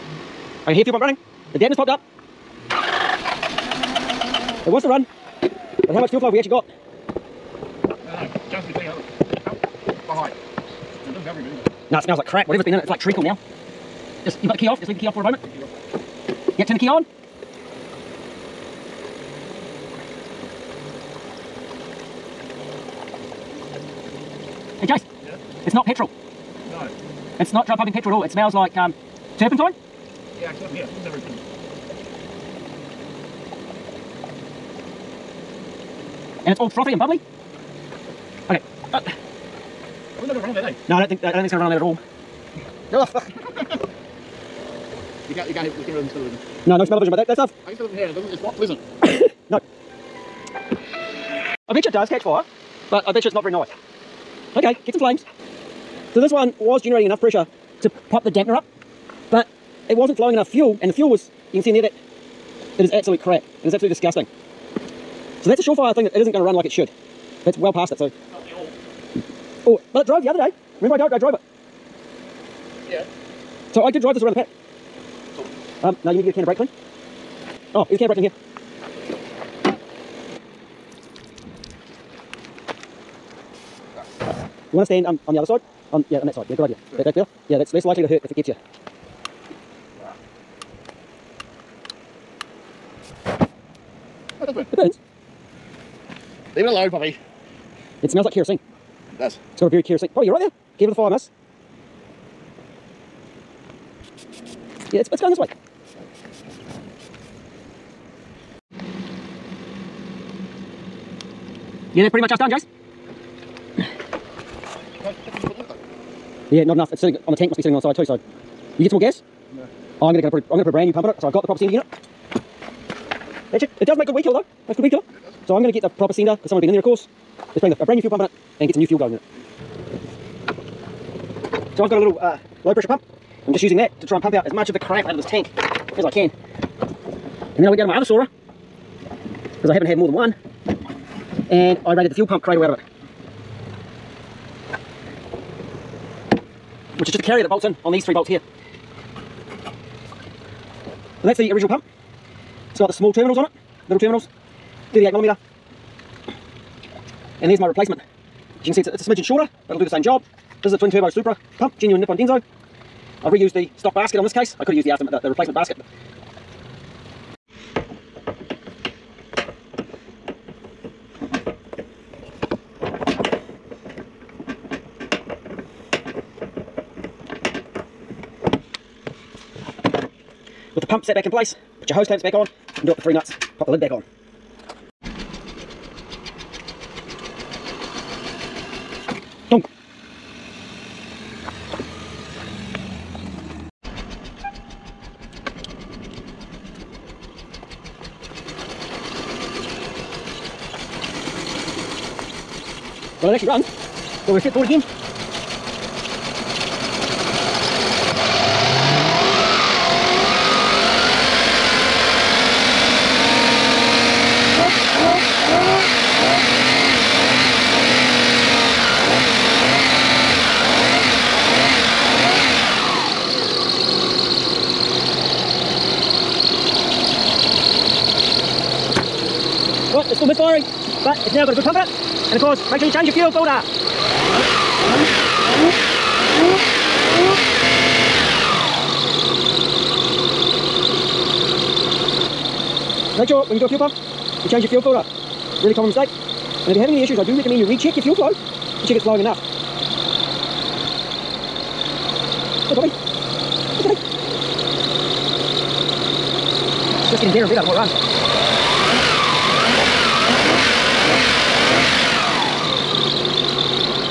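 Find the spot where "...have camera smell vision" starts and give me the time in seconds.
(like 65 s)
45 s.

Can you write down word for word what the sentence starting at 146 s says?
Which is just a carrier that bolts in on these three bolts here.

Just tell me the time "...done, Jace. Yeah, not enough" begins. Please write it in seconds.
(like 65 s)
112 s.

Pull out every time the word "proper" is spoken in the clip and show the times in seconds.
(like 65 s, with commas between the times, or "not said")
121 s, 125 s.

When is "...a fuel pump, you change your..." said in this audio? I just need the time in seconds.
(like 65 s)
243 s.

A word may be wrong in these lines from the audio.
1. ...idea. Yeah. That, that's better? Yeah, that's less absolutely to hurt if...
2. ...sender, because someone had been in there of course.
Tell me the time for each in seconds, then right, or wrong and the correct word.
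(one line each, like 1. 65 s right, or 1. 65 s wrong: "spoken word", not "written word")
1. 86 s wrong: "likely", not "absolutely"
2. 126 s right.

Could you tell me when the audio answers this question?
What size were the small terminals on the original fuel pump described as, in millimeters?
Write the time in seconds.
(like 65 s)
154 s.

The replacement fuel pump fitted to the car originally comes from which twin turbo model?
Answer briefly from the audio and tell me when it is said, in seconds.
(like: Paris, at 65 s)
Supra, at 161 s.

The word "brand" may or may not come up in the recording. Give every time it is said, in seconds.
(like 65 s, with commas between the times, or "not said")
120 s, 127 s.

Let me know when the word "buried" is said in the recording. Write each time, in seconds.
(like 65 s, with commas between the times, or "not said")
not said.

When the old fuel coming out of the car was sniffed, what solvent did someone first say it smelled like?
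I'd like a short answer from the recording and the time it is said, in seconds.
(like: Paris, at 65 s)
Turpentine, at 29 s.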